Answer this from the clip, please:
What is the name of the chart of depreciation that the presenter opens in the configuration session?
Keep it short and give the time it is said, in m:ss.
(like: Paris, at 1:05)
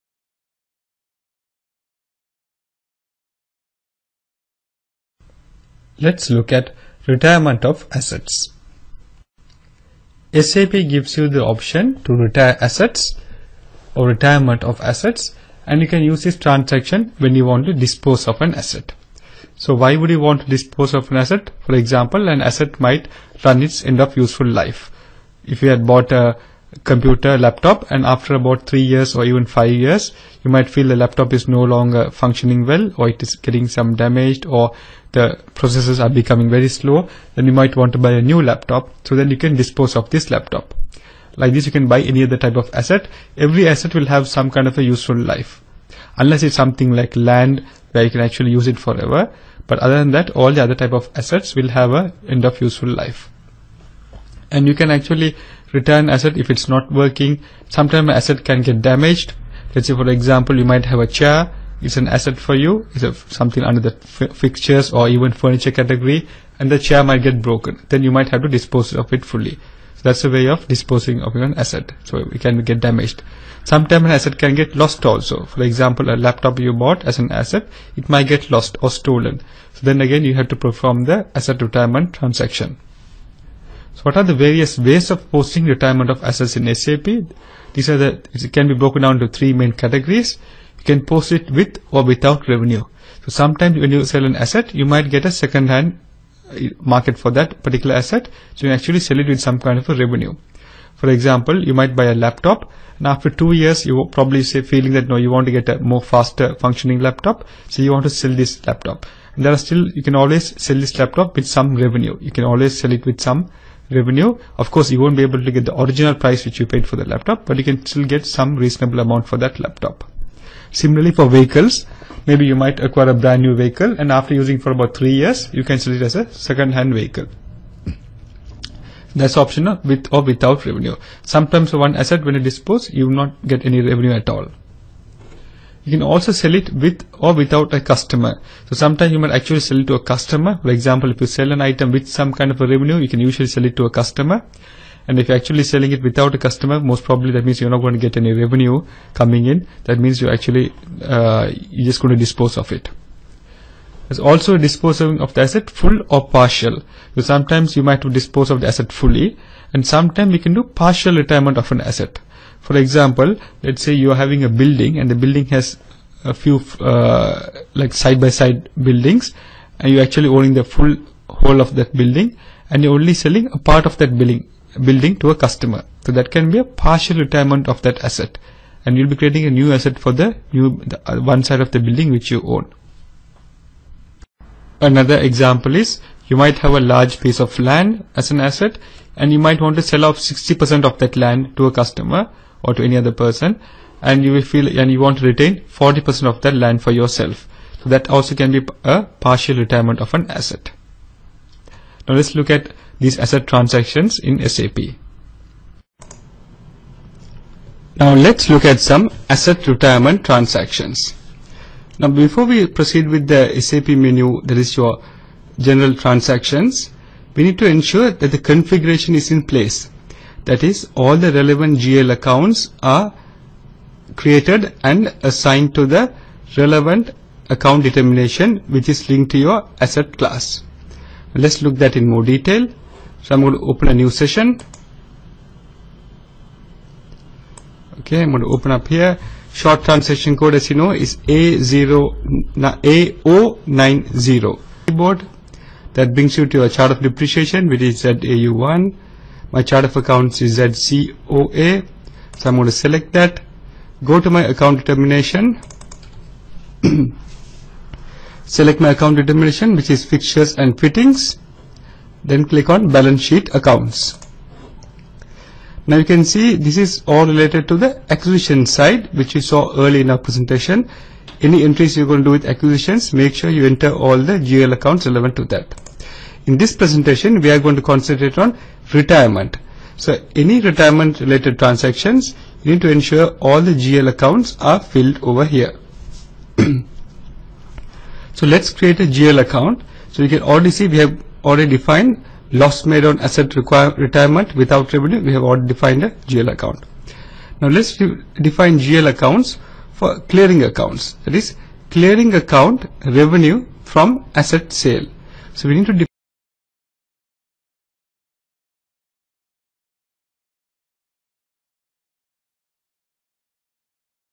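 ZAU1, at 4:08.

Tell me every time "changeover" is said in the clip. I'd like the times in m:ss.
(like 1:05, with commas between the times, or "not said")
not said.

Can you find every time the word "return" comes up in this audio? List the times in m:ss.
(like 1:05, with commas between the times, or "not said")
0:55.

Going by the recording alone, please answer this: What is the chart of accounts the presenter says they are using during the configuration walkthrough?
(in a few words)
COA.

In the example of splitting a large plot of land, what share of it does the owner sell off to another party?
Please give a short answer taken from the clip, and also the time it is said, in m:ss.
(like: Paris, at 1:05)
60%, at 3:10.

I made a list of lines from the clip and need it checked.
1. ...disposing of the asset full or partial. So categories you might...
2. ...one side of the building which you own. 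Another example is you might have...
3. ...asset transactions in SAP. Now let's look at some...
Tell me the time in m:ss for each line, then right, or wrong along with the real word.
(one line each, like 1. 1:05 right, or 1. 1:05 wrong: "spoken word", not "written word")
1. 2:34 wrong: "sometimes", not "categories"
2. 3:01 right
3. 3:23 right.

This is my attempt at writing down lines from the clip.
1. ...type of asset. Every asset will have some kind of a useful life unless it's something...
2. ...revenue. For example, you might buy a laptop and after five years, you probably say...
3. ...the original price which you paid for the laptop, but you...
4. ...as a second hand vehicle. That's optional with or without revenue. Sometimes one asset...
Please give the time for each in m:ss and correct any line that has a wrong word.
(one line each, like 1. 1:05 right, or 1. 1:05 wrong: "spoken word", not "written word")
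1. 0:42 right
2. 1:39 wrong: "two", not "five"
3. 1:55 right
4. 2:06 right.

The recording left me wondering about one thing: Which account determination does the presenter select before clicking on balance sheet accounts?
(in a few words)
fixtures and fittings.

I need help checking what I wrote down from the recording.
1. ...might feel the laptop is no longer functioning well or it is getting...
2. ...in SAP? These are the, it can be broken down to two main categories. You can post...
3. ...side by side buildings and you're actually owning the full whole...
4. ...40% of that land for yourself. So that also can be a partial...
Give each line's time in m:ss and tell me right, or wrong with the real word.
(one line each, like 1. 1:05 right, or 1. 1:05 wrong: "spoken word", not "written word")
1. 0:30 right
2. 1:26 wrong: "three", not "two"
3. 2:47 right
4. 3:15 right.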